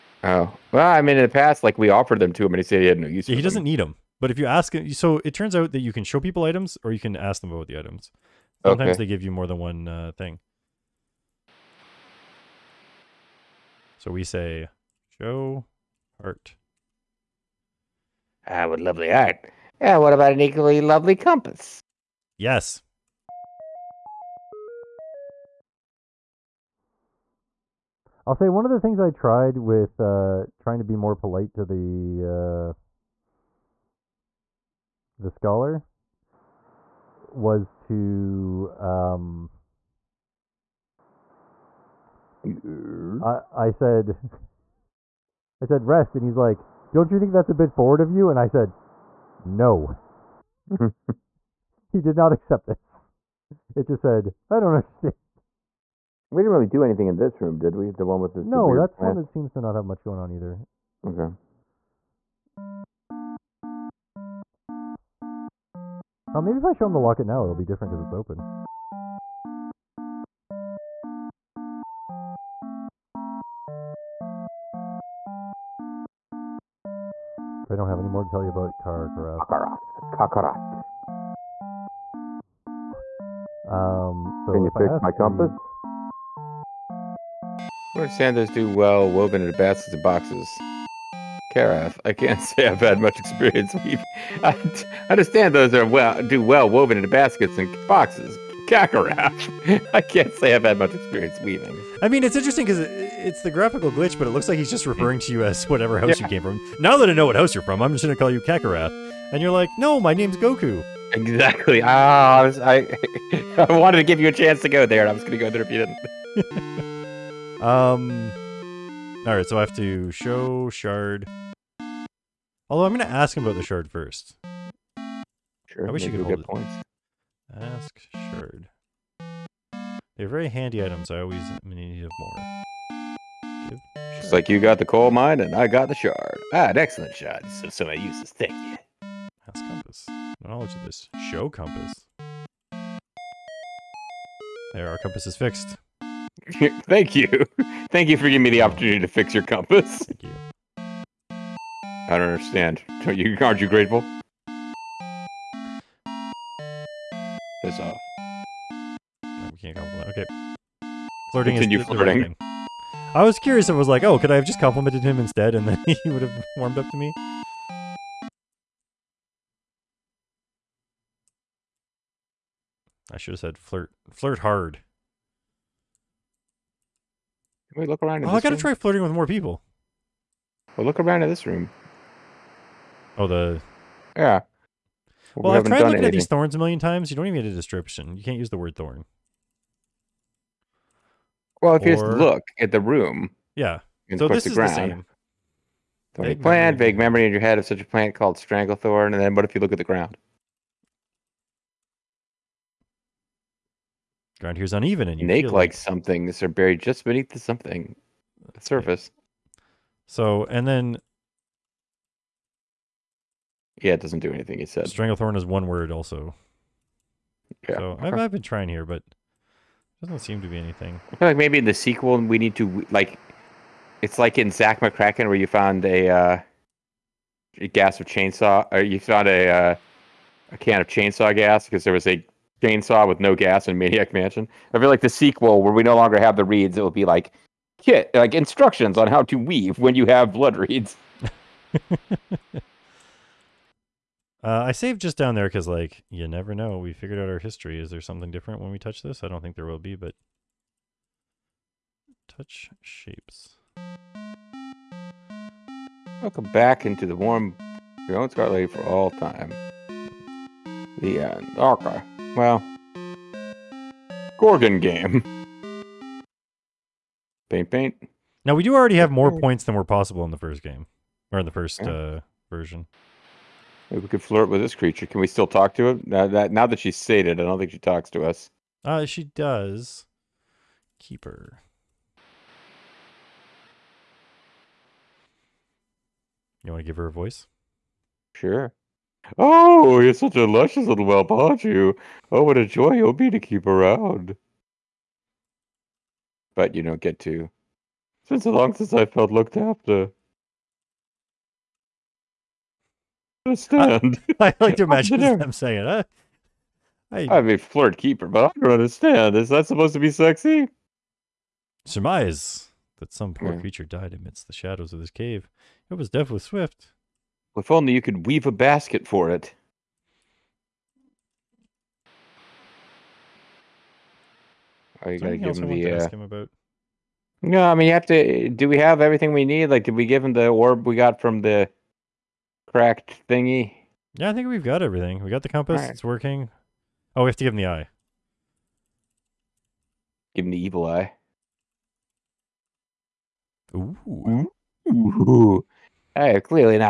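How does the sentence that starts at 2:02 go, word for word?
Although I'm going to ask him about the shard first.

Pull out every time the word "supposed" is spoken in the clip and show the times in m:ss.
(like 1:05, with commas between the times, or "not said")
5:09.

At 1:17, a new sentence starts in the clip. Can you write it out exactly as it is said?
I don't have any more to tell you about Karkaroth.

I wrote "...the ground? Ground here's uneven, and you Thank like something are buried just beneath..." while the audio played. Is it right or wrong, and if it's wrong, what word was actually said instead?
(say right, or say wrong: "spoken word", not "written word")
wrong: "Snake", not "Thank".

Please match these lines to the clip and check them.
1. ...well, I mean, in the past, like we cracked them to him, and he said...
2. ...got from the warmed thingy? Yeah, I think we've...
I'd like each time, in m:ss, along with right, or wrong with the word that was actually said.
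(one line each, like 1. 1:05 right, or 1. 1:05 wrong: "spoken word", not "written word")
1. 0:00 wrong: "offered", not "cracked"
2. 5:30 wrong: "cracked", not "warmed".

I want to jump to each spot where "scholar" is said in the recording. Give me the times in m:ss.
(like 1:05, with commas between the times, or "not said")
0:35.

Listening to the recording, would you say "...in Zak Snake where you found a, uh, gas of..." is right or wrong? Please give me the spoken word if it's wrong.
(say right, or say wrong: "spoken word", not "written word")
wrong: "McKracken", not "Snake".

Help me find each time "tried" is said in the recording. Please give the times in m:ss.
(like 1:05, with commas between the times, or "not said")
0:29, 3:05.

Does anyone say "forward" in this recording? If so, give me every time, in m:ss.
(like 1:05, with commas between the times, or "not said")
0:47.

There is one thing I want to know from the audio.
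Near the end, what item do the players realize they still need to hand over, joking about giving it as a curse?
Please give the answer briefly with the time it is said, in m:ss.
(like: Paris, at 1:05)
the eye, at 5:37.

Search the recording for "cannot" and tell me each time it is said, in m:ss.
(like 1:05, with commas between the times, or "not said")
not said.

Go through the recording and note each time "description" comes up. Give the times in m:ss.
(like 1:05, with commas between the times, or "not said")
3:07.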